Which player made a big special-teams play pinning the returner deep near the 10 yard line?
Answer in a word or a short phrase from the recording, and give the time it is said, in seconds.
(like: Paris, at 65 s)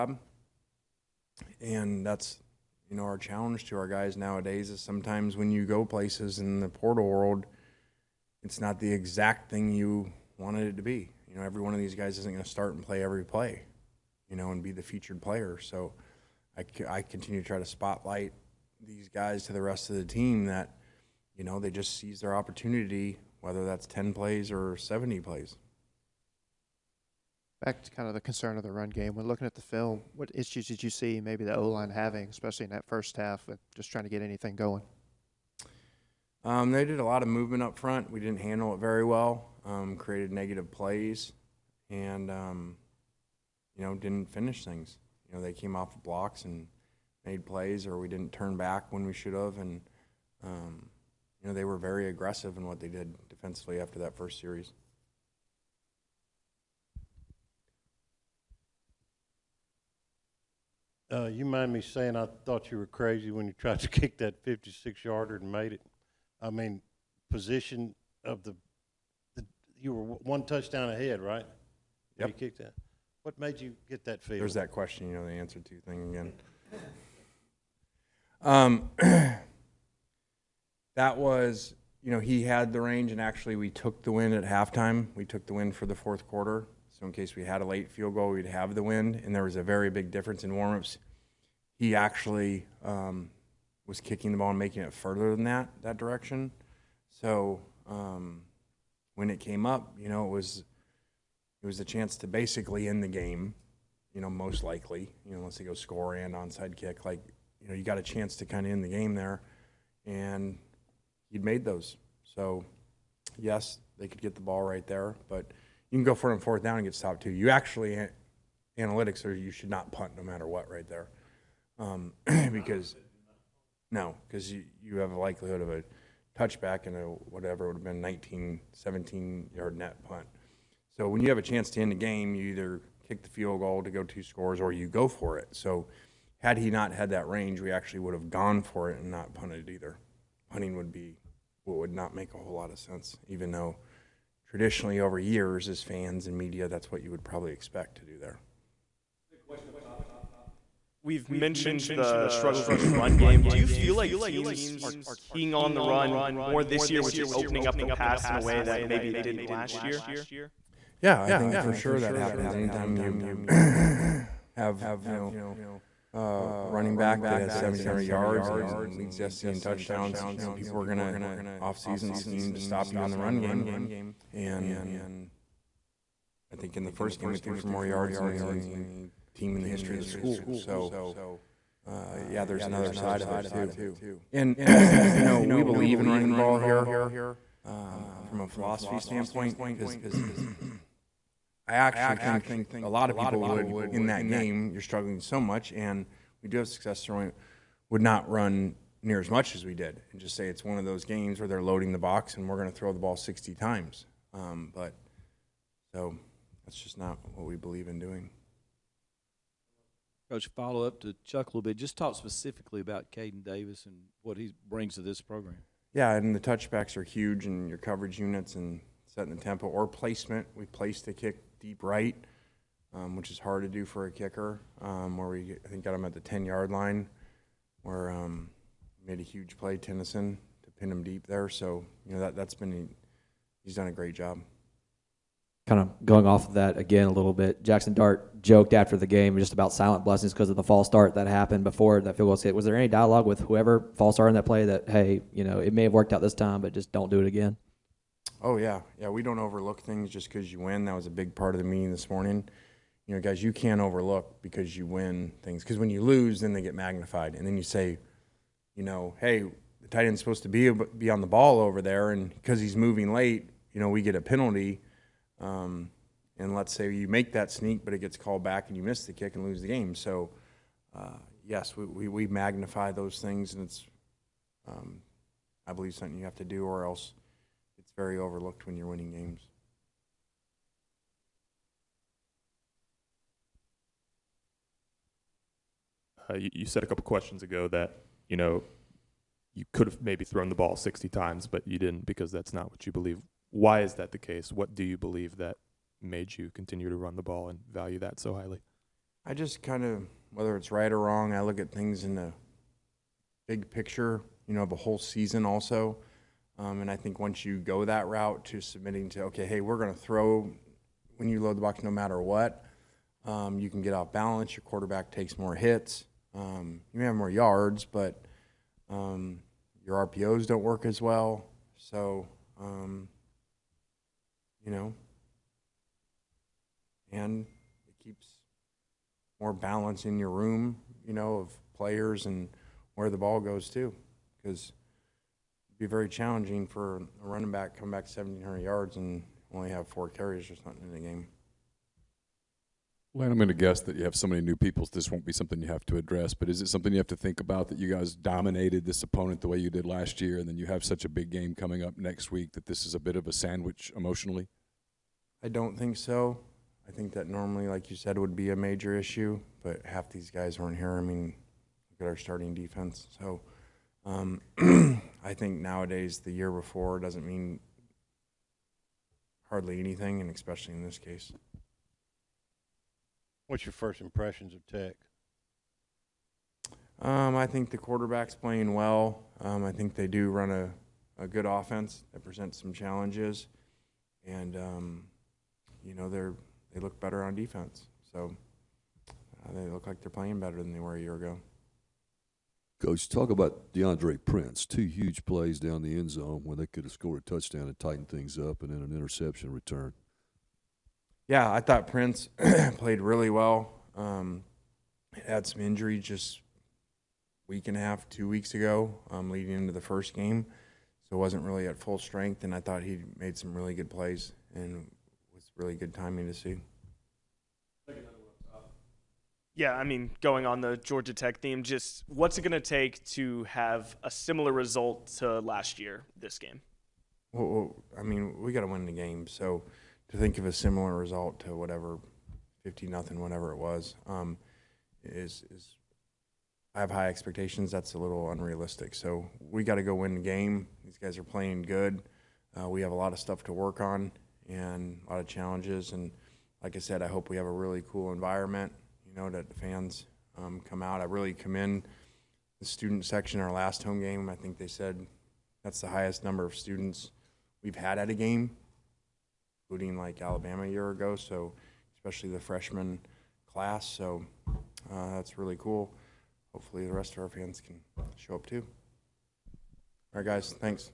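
Tennyson, at 229 s.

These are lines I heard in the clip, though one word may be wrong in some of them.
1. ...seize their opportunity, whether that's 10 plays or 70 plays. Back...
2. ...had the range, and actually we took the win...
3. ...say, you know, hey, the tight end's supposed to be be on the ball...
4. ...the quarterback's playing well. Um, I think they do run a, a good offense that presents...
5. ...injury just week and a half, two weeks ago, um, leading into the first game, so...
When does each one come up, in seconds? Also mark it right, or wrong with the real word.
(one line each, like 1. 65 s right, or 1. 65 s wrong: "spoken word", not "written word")
1. 21 s right
2. 82 s right
3. 257 s right
4. 377 s right
5. 405 s right.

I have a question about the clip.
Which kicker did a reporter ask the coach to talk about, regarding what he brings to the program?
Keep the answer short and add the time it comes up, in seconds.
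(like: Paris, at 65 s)
Caden Davis, at 213 s.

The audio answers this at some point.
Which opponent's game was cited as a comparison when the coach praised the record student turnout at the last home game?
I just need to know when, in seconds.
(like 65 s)
460 s.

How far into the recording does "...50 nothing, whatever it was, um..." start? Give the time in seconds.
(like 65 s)
432 s.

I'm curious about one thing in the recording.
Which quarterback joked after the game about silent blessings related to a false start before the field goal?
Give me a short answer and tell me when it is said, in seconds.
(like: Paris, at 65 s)
Jackson Dart, at 237 s.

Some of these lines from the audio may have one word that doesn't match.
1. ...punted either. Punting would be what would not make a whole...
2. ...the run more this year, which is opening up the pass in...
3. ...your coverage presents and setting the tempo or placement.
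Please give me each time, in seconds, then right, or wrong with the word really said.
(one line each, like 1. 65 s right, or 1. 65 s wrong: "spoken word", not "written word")
1. 139 s right
2. 155 s right
3. 217 s wrong: "units", not "presents".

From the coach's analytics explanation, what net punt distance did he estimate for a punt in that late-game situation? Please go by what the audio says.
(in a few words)
19 or 17 yards.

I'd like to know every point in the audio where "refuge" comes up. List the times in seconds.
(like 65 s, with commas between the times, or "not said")
not said.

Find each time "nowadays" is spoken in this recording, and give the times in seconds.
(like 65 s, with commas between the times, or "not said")
4 s, 365 s.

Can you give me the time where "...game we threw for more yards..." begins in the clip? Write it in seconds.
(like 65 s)
177 s.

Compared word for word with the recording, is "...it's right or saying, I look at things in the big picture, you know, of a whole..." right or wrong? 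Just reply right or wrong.
wrong.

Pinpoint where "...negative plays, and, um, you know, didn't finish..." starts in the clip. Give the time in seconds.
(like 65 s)
40 s.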